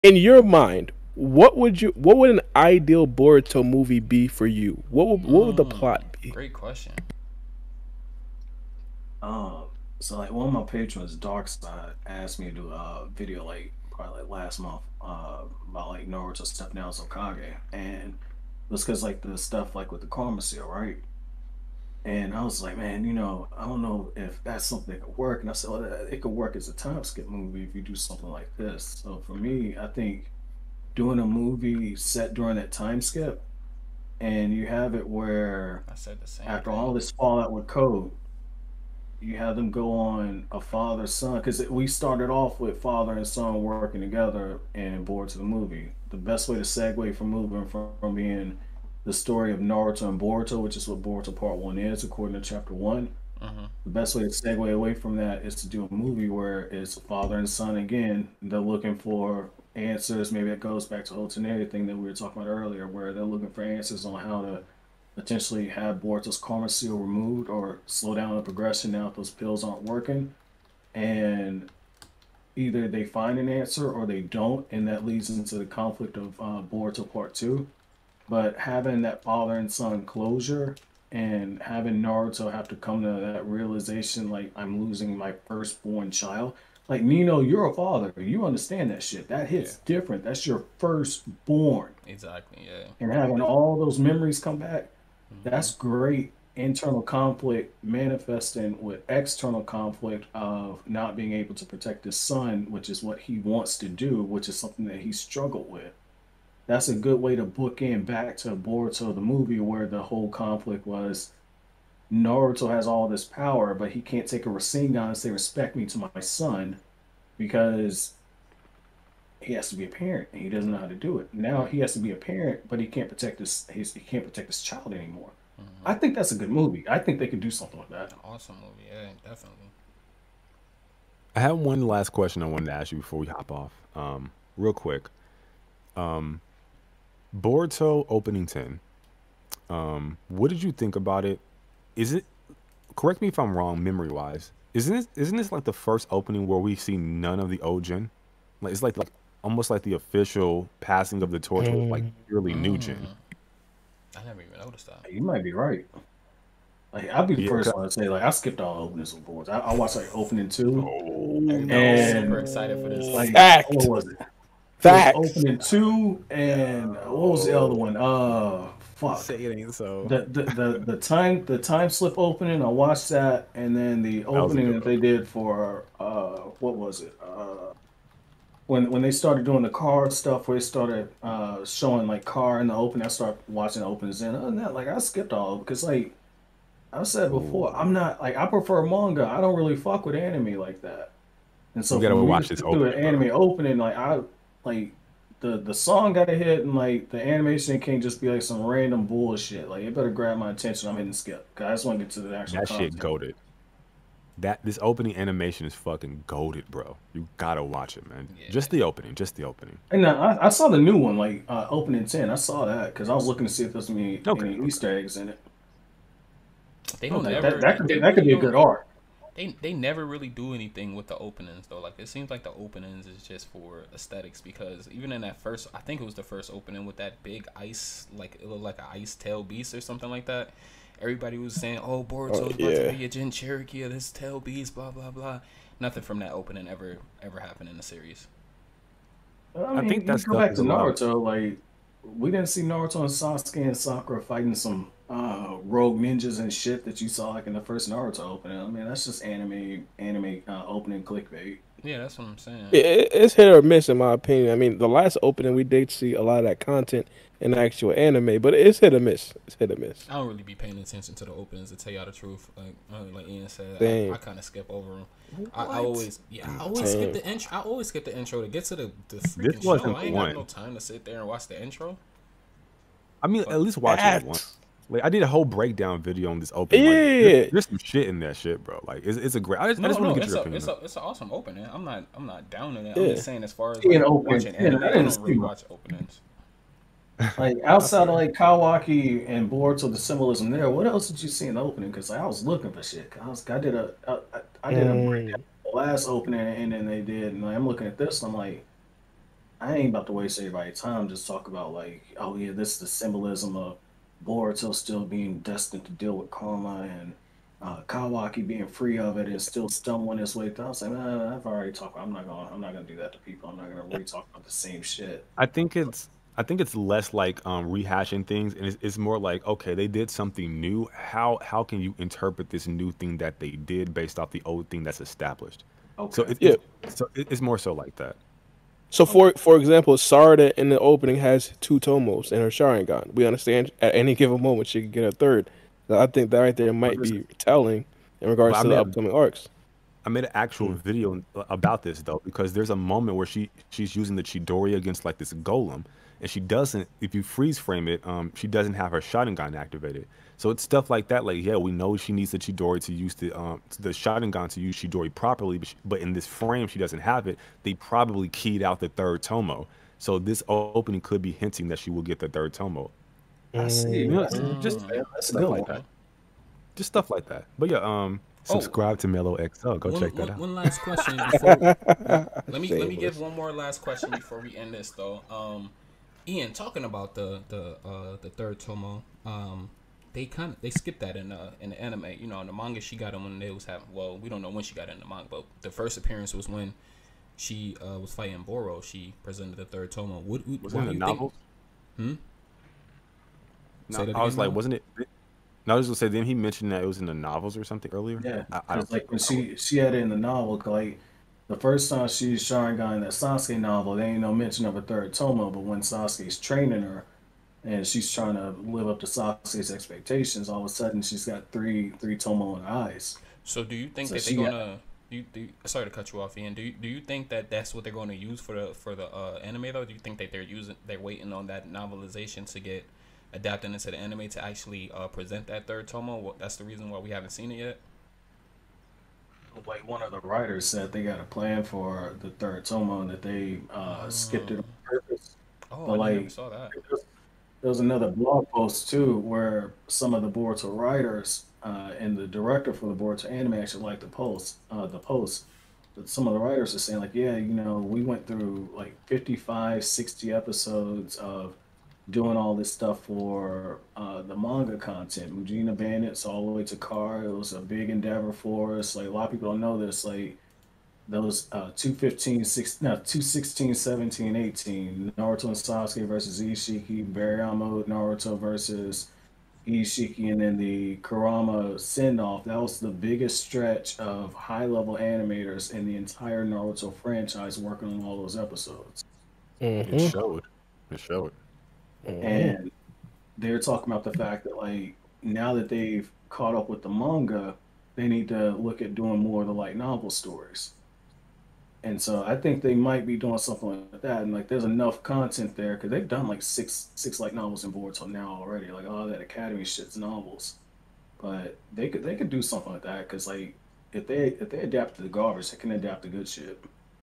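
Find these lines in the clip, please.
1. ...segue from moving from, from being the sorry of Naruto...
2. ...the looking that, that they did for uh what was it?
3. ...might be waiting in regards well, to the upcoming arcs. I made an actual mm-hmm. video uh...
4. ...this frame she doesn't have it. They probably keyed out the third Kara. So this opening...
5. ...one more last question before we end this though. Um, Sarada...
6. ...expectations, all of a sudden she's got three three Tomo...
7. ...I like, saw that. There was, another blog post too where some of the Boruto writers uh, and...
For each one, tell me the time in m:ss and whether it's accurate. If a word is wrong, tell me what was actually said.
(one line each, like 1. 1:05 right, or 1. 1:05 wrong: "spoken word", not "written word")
1. 0:46 wrong: "story", not "sorry"
2. 2:54 wrong: "opening", not "looking"
3. 5:36 wrong: "telling", not "waiting"
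4. 5:56 wrong: "Tomo", not "Kara"
5. 6:13 wrong: "Ian", not "Sarada"
6. 6:49 right
7. 7:15 right.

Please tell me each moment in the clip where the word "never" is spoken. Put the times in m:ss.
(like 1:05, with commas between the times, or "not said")
2:34, 3:39.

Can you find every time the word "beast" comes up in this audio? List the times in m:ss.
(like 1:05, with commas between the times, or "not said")
3:49, 3:54.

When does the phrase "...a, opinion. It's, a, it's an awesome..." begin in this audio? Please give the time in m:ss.
4:40.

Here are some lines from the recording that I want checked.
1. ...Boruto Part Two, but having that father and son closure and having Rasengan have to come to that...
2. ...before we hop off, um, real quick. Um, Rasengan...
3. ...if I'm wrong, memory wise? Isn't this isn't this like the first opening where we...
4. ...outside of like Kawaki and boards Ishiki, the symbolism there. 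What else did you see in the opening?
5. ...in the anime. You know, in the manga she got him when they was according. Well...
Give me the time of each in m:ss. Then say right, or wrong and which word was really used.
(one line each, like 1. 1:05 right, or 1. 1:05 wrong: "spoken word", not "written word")
1. 1:16 wrong: "Naruto", not "Rasengan"
2. 2:12 wrong: "Boruto", not "Rasengan"
3. 2:23 right
4. 4:47 wrong: "Boruto", not "Ishiki"
5. 6:21 wrong: "having", not "according".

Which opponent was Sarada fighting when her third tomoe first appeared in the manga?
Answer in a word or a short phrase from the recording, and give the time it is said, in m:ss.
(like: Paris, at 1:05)
Boro, at 6:28.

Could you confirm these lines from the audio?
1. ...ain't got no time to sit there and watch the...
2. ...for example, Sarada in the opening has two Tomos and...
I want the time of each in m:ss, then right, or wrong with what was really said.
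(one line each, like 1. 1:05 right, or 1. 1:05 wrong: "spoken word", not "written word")
1. 4:30 right
2. 5:29 right.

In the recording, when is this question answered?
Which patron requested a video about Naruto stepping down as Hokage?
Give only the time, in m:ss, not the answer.
0:11.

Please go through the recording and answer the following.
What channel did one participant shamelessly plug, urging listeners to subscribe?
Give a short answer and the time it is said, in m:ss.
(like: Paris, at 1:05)
Mello XL, at 6:09.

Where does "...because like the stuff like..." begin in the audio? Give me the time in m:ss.
0:18.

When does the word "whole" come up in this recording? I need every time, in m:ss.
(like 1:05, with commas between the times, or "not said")
1:01, 1:50, 4:35.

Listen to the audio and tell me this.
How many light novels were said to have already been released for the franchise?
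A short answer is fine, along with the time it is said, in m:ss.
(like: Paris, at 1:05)
6, at 8:16.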